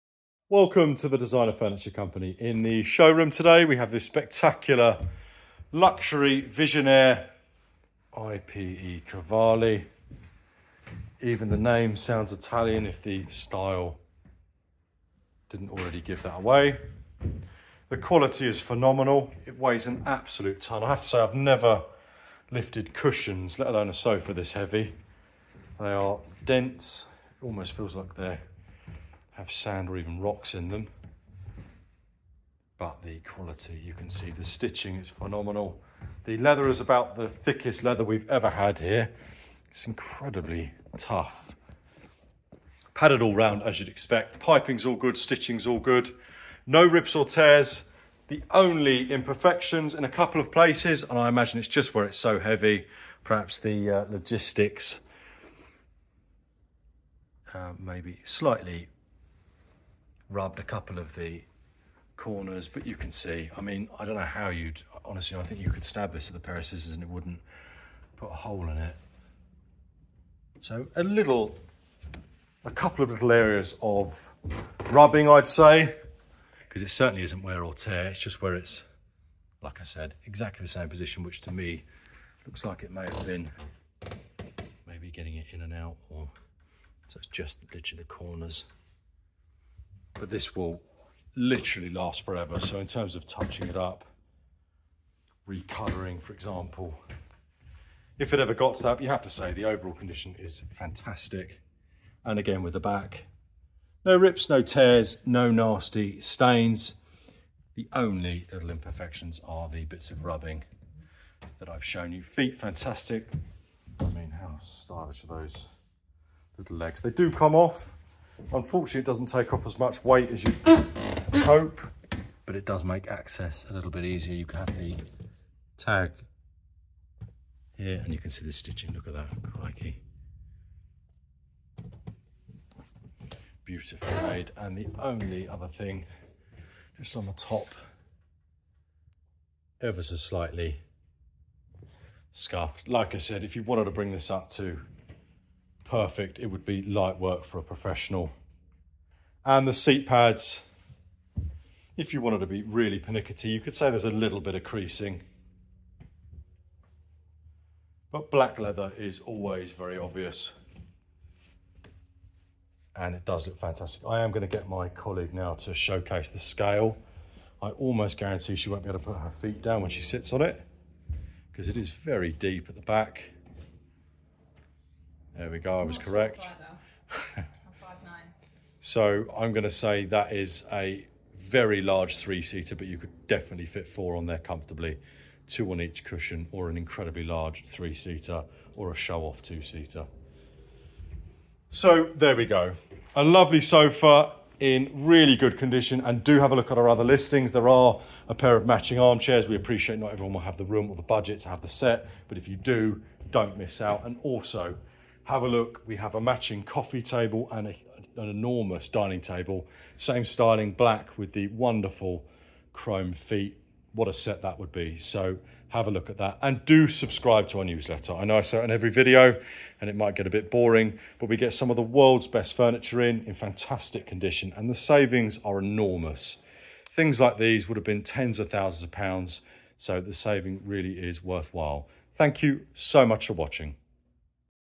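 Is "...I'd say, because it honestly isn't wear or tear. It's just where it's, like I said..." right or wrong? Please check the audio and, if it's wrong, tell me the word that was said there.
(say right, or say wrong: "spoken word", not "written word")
wrong: "certainly", not "honestly".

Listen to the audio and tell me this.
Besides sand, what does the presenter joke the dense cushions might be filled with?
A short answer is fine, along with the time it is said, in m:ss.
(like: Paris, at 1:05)
Rocks, at 0:30.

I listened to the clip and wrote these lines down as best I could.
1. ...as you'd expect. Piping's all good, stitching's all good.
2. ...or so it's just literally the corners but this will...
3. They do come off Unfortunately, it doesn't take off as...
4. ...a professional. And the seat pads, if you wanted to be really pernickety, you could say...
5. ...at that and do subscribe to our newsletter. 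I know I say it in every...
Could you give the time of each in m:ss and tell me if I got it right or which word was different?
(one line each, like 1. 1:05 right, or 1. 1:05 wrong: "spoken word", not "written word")
1. 0:43 right
2. 1:26 right
3. 1:57 right
4. 2:27 right
5. 3:36 right.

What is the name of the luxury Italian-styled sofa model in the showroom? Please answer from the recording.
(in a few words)
Visionnaire IPE Cavalli.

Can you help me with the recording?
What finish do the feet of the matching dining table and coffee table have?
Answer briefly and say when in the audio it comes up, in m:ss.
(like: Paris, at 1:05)
Chrome, at 3:32.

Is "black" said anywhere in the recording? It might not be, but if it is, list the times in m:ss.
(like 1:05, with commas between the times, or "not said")
2:38, 3:30.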